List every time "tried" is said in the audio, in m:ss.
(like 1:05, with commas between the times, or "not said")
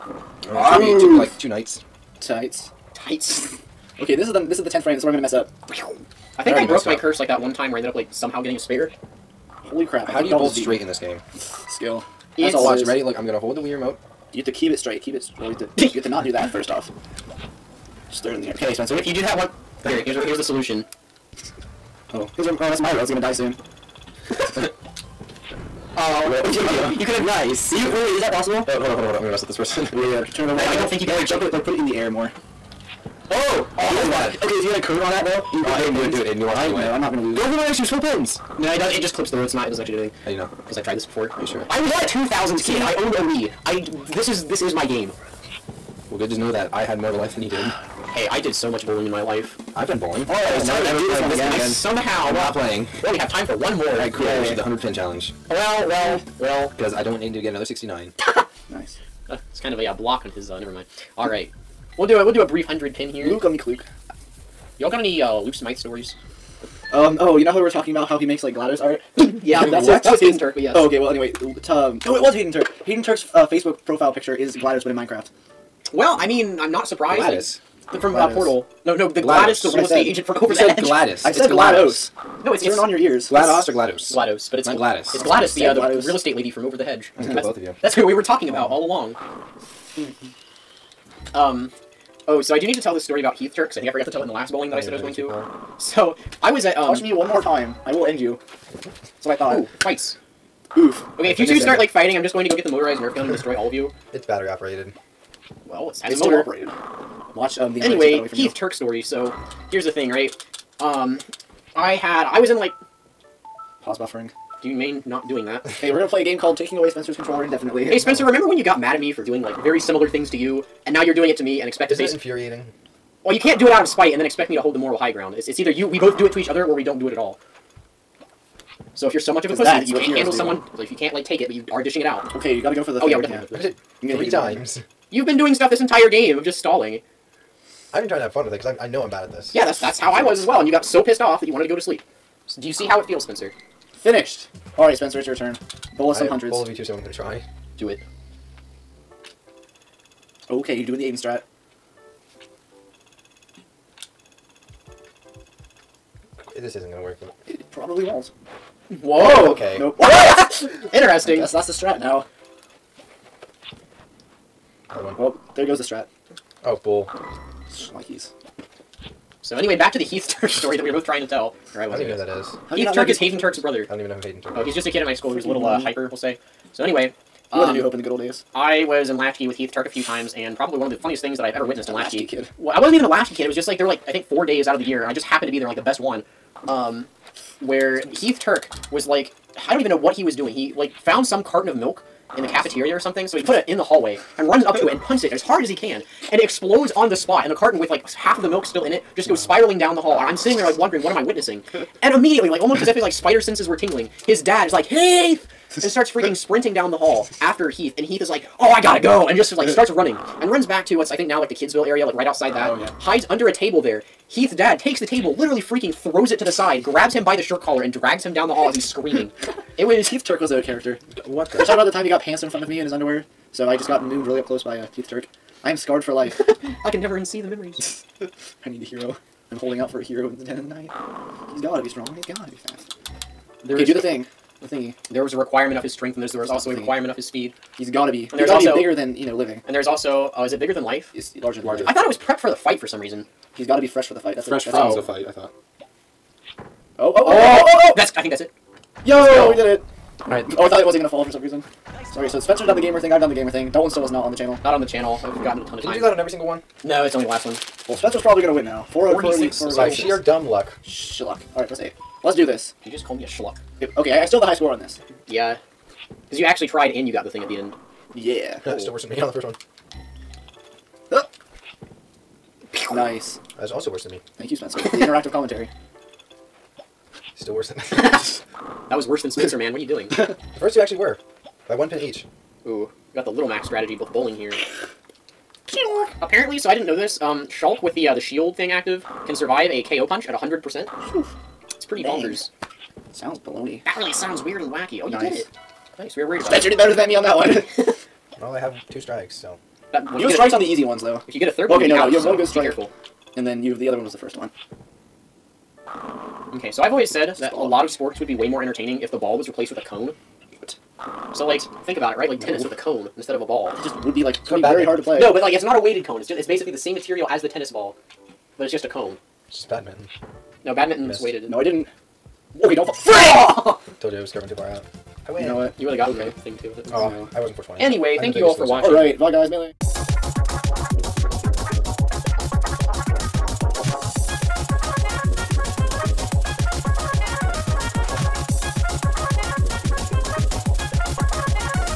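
0:40, 4:26.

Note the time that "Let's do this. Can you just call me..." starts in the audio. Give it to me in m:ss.
4:22.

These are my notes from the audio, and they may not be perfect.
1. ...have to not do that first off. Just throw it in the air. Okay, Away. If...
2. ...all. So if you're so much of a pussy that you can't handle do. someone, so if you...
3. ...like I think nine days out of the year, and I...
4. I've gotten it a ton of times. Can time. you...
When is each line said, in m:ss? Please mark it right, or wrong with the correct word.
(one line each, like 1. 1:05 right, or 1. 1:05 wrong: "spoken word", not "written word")
1. 0:15 wrong: "Spencer", not "Away"
2. 2:07 right
3. 3:03 wrong: "four", not "nine"
4. 4:15 right.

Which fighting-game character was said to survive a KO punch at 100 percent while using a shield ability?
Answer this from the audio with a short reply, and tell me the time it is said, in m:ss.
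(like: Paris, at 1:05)
Shulk, at 4:47.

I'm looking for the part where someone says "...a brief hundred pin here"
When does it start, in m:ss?
1:02.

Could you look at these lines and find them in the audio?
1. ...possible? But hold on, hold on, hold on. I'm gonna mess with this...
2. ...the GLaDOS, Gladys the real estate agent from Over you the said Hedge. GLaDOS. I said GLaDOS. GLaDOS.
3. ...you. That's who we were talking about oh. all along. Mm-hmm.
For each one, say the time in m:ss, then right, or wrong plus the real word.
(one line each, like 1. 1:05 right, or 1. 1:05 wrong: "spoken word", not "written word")
1. 0:28 right
2. 1:19 right
3. 1:27 right.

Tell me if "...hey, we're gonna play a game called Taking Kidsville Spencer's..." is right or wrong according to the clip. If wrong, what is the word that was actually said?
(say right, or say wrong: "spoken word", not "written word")
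wrong: "Away", not "Kidsville".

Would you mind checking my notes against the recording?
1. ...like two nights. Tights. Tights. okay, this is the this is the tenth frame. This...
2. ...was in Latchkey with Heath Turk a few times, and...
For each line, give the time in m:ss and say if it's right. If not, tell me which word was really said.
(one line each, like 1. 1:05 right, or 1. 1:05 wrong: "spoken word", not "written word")
1. 0:01 right
2. 2:58 right.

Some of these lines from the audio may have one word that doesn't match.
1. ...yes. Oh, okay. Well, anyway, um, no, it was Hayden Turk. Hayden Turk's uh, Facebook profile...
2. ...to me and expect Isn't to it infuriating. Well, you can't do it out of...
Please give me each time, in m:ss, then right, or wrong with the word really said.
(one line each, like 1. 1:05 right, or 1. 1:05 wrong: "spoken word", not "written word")
1. 1:10 right
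2. 2:01 right.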